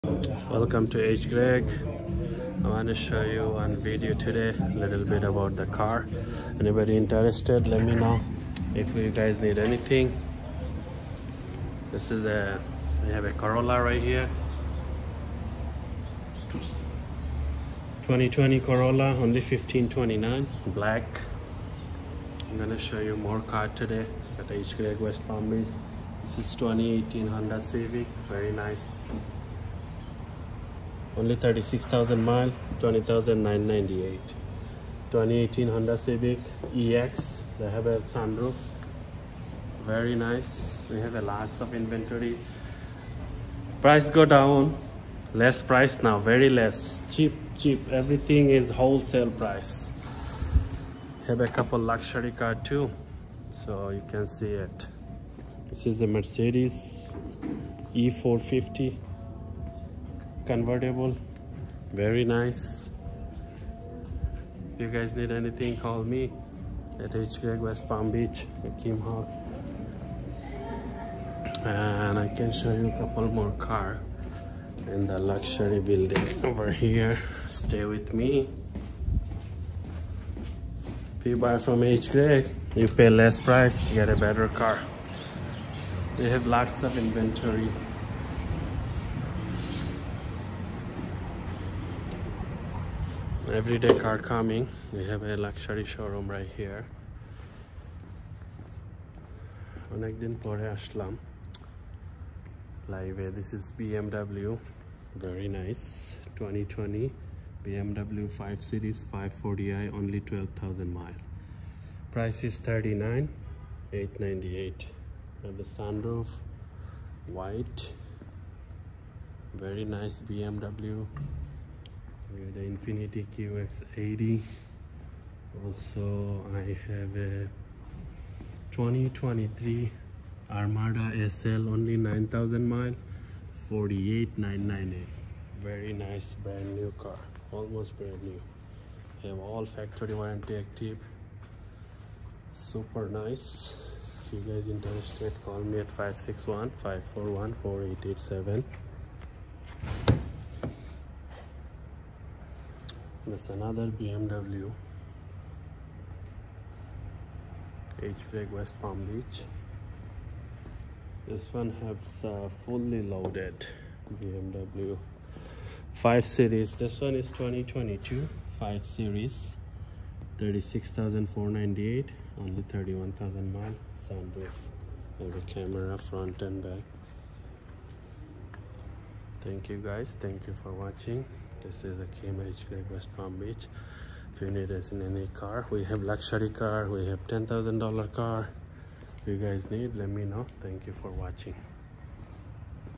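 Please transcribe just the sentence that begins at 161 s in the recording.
This one has uh, fully loaded BMW 5 Series.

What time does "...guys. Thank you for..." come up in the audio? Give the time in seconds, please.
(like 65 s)
179 s.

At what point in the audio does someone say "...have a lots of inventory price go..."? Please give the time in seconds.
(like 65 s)
40 s.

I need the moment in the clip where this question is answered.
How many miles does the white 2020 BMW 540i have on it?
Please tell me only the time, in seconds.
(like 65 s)
110 s.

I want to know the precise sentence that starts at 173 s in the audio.
Sunroof, every camera front and back.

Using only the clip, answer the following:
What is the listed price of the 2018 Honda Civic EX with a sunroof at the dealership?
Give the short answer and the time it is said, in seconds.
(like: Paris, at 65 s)
$20,998, at 32 s.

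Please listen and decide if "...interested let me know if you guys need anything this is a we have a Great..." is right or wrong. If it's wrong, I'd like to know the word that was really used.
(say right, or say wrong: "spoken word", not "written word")
wrong: "Corolla", not "Great".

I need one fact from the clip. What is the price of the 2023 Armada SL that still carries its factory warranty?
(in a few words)
$48,998.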